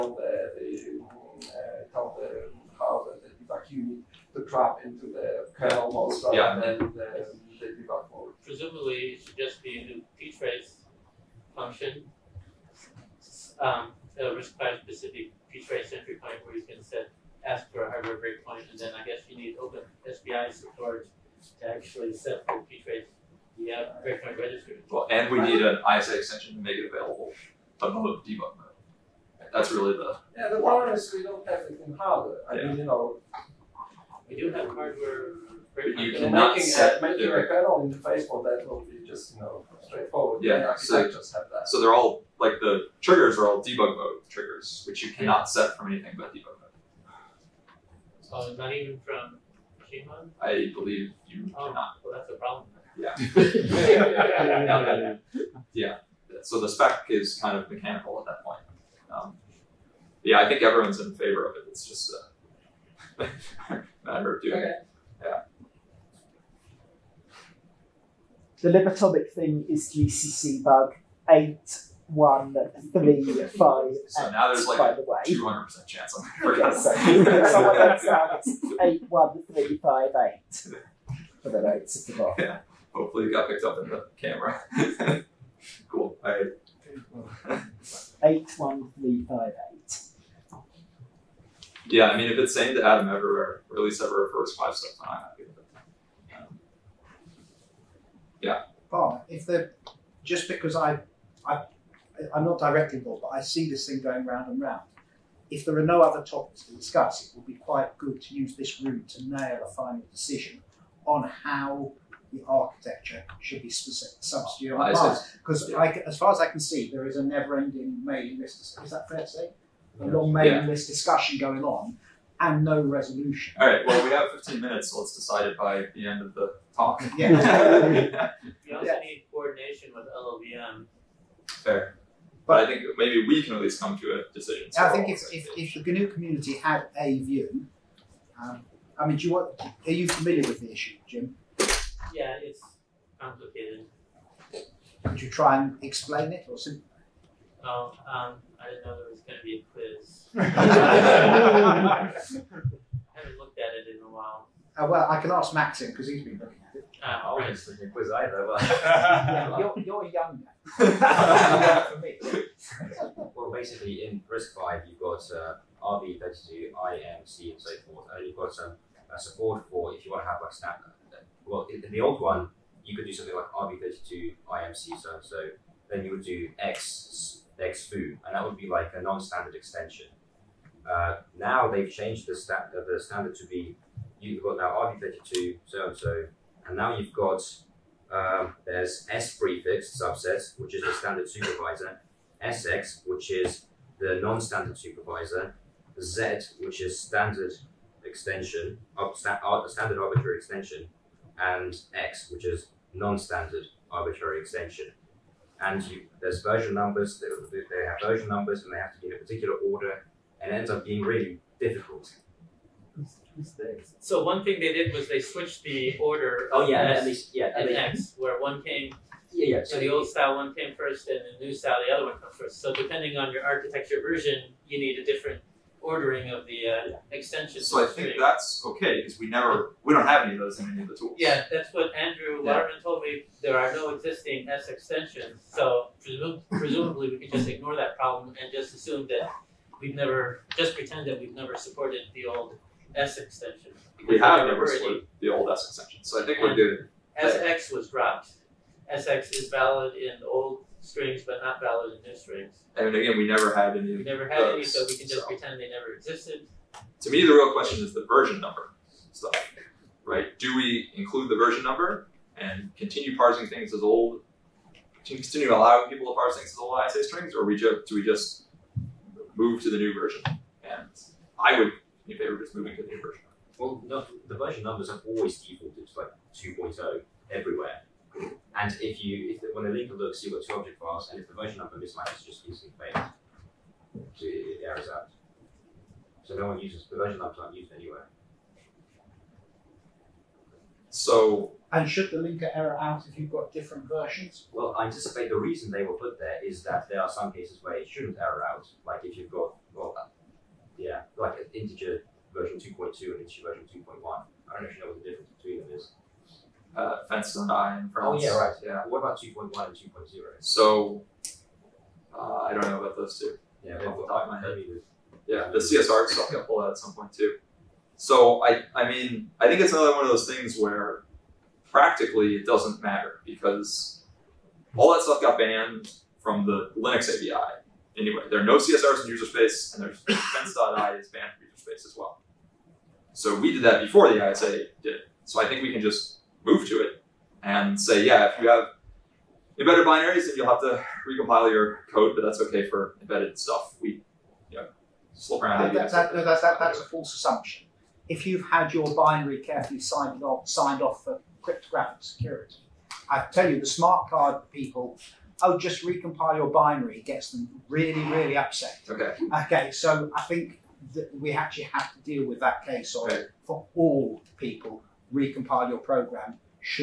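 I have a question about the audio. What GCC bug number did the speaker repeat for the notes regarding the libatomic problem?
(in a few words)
81358.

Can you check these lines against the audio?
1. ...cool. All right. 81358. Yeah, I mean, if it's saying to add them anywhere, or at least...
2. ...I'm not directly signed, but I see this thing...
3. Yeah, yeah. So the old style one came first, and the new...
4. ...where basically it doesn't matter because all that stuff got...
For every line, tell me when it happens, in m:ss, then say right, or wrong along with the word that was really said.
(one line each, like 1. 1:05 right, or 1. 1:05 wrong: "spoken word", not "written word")
1. 1:25 wrong: "everywhere", not "anywhere"
2. 1:42 wrong: "involved", not "signed"
3. 3:39 right
4. 5:20 wrong: "practically", not "basically".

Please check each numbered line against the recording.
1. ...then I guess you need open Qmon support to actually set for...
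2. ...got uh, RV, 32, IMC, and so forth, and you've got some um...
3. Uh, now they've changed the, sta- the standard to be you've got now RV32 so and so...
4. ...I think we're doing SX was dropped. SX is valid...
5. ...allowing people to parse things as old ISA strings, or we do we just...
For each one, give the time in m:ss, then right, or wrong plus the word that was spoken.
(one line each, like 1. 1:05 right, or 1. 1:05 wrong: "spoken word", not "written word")
1. 0:18 wrong: "SBI", not "Qmon"
2. 2:44 right
3. 3:00 right
4. 4:06 right
5. 4:25 right.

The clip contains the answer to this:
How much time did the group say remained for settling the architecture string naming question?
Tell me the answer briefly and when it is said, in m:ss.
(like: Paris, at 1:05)
15 minutes, at 2:04.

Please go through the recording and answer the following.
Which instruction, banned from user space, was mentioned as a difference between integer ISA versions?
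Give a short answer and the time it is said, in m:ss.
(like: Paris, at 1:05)
fence.i, at 5:29.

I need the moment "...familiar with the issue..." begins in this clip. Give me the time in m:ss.
2:20.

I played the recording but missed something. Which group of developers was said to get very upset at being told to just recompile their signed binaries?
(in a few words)
smart card people.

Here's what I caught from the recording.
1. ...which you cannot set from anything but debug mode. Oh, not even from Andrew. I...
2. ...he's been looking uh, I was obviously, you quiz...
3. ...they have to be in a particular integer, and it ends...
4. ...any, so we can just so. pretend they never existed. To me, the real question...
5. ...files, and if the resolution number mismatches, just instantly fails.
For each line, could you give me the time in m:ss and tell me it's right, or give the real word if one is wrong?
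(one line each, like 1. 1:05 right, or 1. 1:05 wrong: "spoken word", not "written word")
1. 0:44 wrong: "Qmon", not "Andrew"
2. 2:36 right
3. 3:28 wrong: "order", not "integer"
4. 4:14 right
5. 4:40 wrong: "version", not "resolution".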